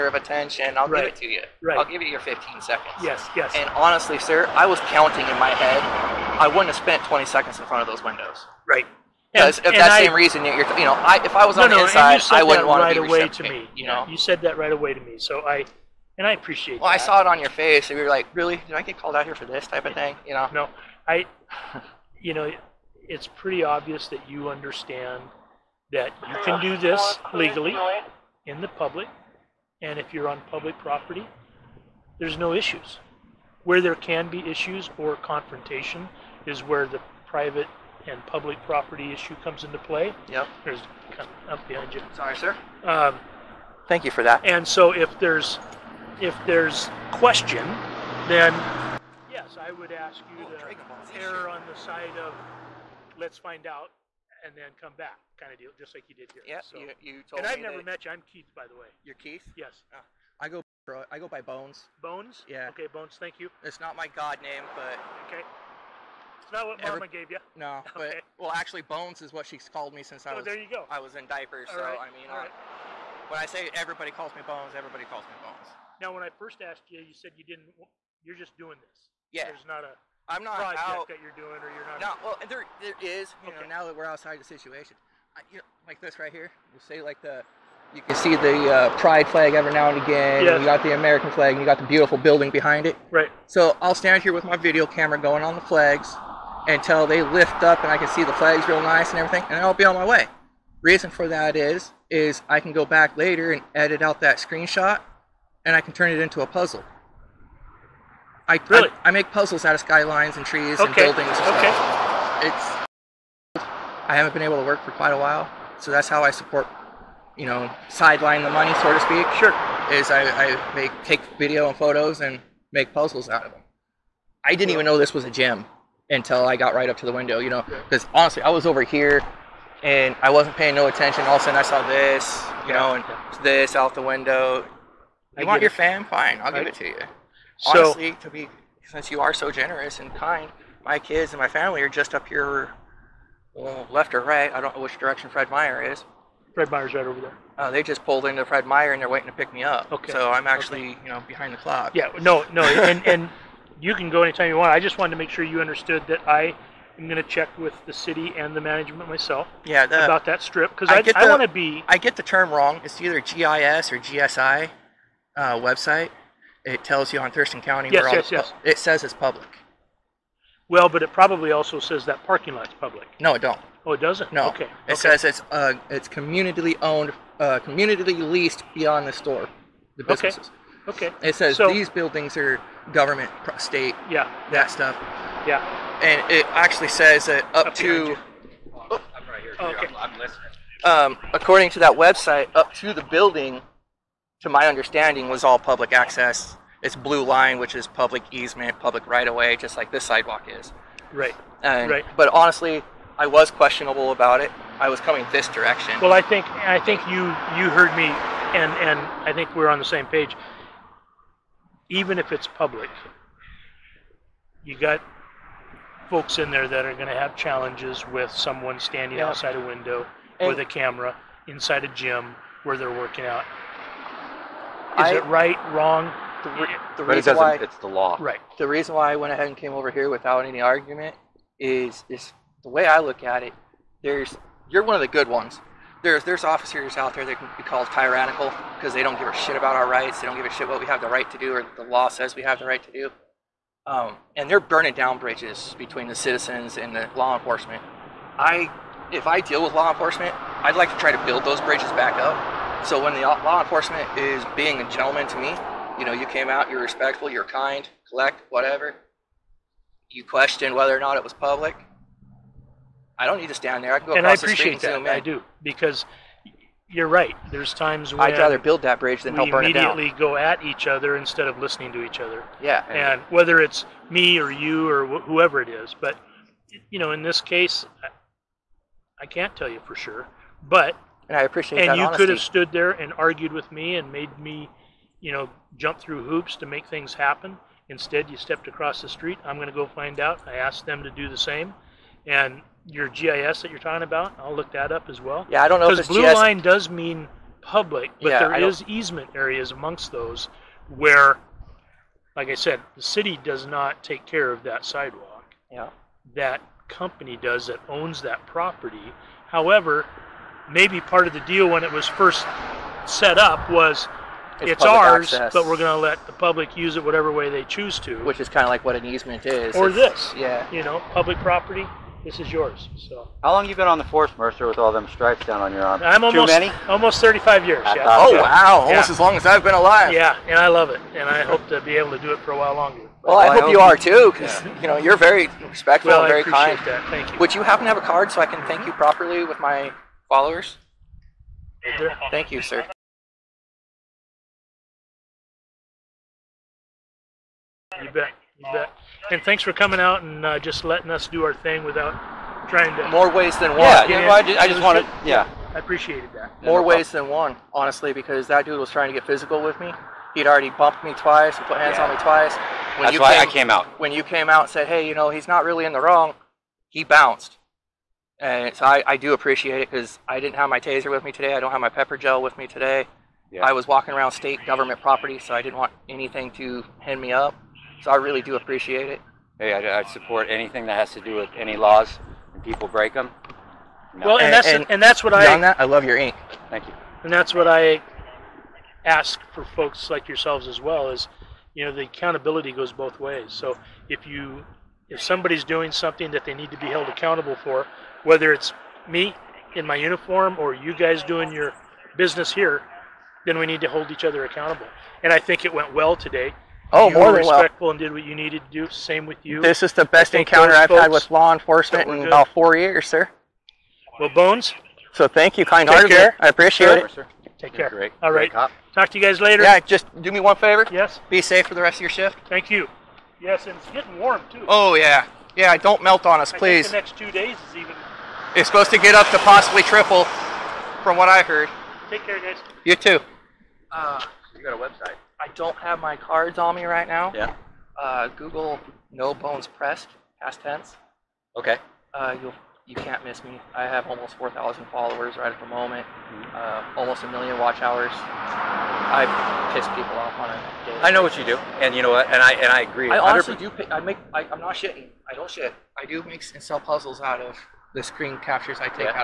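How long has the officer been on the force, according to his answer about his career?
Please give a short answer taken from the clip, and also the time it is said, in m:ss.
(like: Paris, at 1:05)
Almost 35 years, at 5:26.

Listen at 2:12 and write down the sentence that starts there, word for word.
know, and this out the window.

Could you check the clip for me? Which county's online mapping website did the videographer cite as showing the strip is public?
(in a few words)
Thurston County.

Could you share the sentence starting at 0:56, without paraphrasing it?
Yeah, so, you, you told And I've never met you.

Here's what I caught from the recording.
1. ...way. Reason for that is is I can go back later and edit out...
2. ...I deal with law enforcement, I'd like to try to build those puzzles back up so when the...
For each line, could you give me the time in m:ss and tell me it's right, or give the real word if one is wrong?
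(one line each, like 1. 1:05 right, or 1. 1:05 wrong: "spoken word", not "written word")
1. 1:40 right
2. 4:09 wrong: "bridges", not "puzzles".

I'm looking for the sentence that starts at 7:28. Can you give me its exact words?
I piss people off on a daily.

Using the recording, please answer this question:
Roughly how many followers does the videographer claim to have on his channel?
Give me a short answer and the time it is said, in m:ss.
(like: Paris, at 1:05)
Almost 4,000, at 7:24.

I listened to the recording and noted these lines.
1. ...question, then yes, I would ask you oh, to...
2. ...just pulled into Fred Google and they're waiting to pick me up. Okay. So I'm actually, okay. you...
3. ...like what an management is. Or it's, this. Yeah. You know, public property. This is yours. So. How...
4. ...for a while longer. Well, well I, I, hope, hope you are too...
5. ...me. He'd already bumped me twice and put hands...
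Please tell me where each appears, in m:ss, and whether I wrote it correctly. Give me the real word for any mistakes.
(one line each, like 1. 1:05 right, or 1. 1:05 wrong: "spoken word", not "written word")
1. 0:47 right
2. 2:27 wrong: "Meyer", not "Google"
3. 5:18 wrong: "easement", not "management"
4. 5:32 right
5. 5:59 right.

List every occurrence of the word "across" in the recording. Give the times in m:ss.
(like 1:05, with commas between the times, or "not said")
4:24, 4:48.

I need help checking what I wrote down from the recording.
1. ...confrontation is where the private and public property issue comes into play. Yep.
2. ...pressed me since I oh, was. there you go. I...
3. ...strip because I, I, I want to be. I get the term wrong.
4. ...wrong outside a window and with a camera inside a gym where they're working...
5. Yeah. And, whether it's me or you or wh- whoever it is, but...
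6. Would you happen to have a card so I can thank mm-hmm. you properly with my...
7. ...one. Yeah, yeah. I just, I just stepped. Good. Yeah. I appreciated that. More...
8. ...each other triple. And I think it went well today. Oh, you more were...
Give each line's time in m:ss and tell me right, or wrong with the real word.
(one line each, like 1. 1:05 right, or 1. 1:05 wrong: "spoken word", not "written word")
1. 0:35 right
2. 1:09 wrong: "called", not "pressed"
3. 2:40 right
4. 3:38 wrong: "standing", not "wrong"
5. 4:32 right
6. 5:37 right
7. 5:53 wrong: "wanted", not "stepped"
8. 6:44 wrong: "accountable", not "triple".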